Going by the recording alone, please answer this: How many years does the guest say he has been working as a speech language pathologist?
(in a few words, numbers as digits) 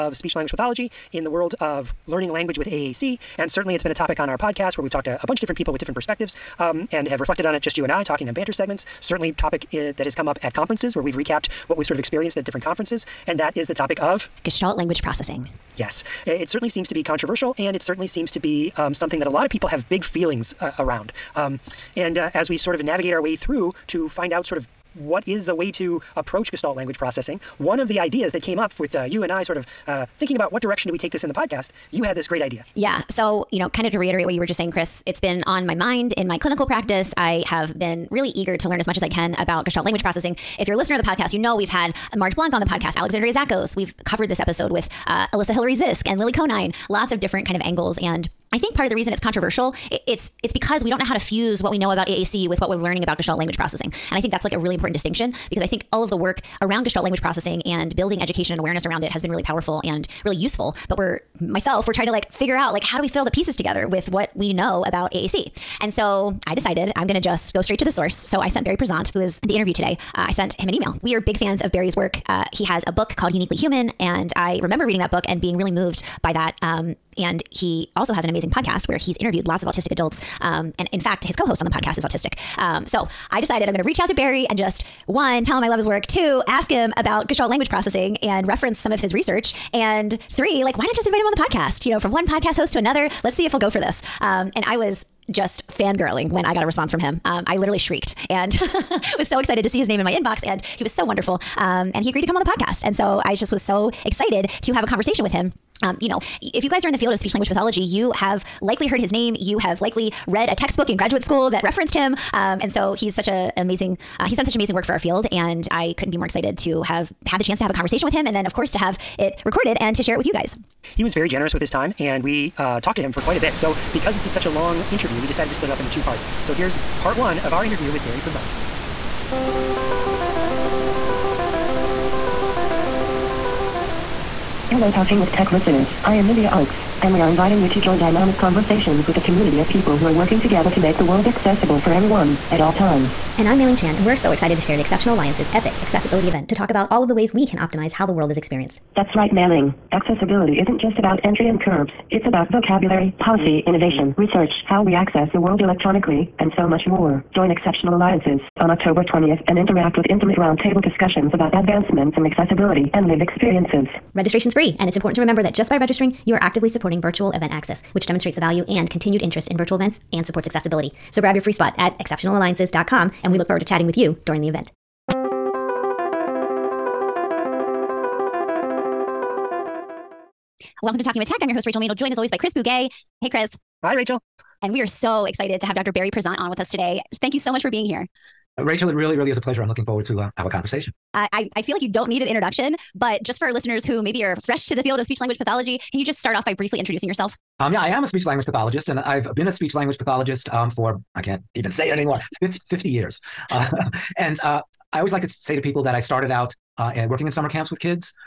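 50.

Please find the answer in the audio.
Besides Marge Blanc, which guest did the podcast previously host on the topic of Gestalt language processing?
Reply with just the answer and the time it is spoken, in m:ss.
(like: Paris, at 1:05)
Alexandria Zakos, at 0:42.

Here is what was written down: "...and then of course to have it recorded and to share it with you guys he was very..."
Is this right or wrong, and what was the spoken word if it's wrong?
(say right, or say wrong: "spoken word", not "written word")
right.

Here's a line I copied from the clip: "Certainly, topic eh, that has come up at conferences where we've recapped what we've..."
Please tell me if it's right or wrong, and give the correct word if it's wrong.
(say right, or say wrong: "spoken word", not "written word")
right.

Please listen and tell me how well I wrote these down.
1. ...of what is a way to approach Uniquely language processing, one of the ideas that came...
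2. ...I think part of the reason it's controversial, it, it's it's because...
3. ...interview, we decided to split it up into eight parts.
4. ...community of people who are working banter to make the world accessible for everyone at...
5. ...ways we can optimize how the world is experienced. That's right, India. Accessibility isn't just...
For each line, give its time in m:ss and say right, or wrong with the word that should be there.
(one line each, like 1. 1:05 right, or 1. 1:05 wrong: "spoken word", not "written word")
1. 0:24 wrong: "Gestalt", not "Uniquely"
2. 0:48 right
3. 2:04 wrong: "two", not "eight"
4. 2:19 wrong: "together", not "banter"
5. 2:27 wrong: "Mailing", not "India".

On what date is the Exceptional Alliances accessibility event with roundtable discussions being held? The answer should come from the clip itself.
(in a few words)
October 20th.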